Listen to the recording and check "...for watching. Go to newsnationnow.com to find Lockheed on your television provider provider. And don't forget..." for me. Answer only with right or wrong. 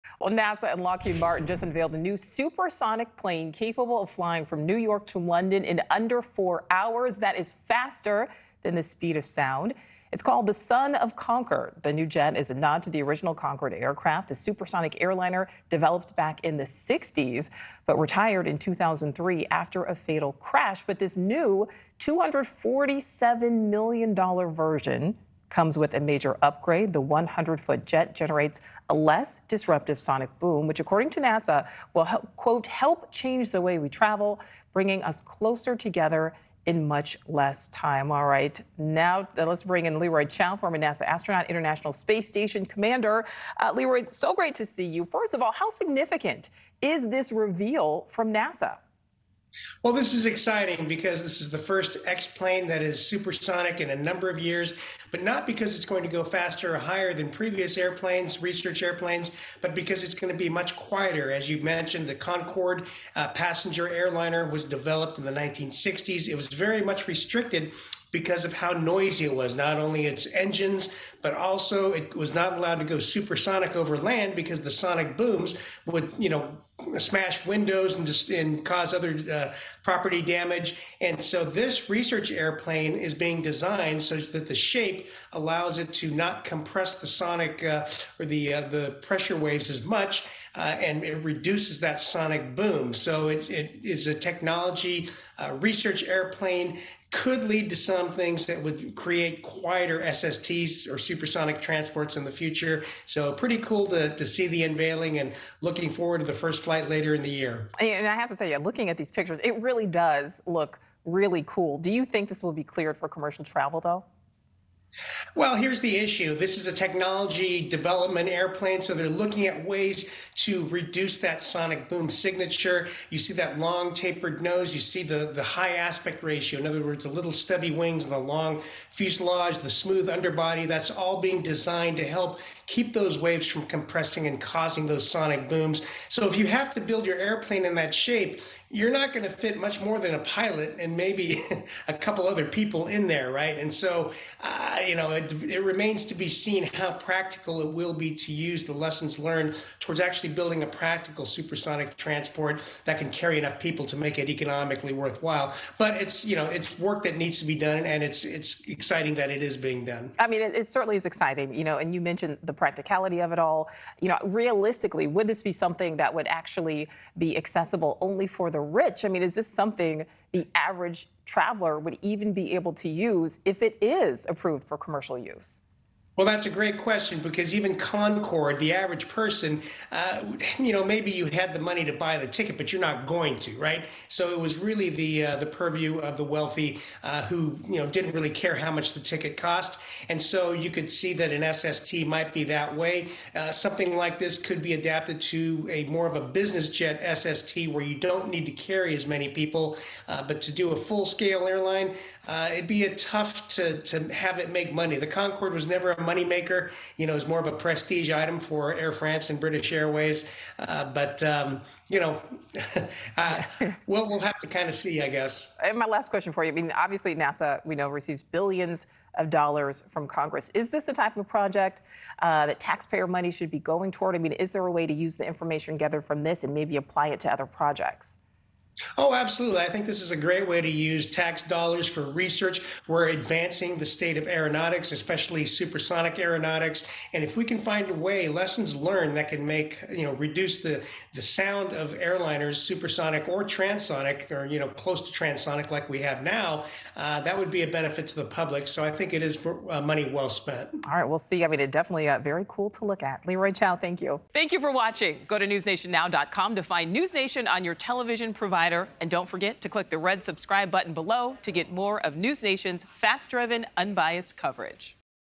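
wrong.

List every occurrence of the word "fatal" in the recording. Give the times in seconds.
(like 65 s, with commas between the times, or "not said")
19 s.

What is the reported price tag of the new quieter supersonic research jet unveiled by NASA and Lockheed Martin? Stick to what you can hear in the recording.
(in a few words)
$247 million.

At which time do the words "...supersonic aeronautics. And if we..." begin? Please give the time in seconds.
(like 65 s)
235 s.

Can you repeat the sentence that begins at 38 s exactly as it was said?
All right, now uh, let's bring in Leroy Chiao, former NASA astronaut, International Space Station commander.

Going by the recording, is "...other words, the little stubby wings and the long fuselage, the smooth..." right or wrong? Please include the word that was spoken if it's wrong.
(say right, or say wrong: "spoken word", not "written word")
right.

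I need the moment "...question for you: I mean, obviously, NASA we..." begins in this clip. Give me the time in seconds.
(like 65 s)
216 s.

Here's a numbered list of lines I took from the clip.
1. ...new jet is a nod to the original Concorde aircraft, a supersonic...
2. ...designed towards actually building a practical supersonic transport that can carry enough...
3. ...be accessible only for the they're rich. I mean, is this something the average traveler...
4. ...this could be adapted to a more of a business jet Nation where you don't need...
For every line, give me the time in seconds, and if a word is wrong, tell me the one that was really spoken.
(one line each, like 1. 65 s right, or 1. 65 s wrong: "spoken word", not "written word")
1. 11 s right
2. 149 s wrong: "learned", not "designed"
3. 167 s right
4. 194 s wrong: "SST", not "Nation".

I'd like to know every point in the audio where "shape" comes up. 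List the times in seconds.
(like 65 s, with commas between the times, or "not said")
84 s, 137 s.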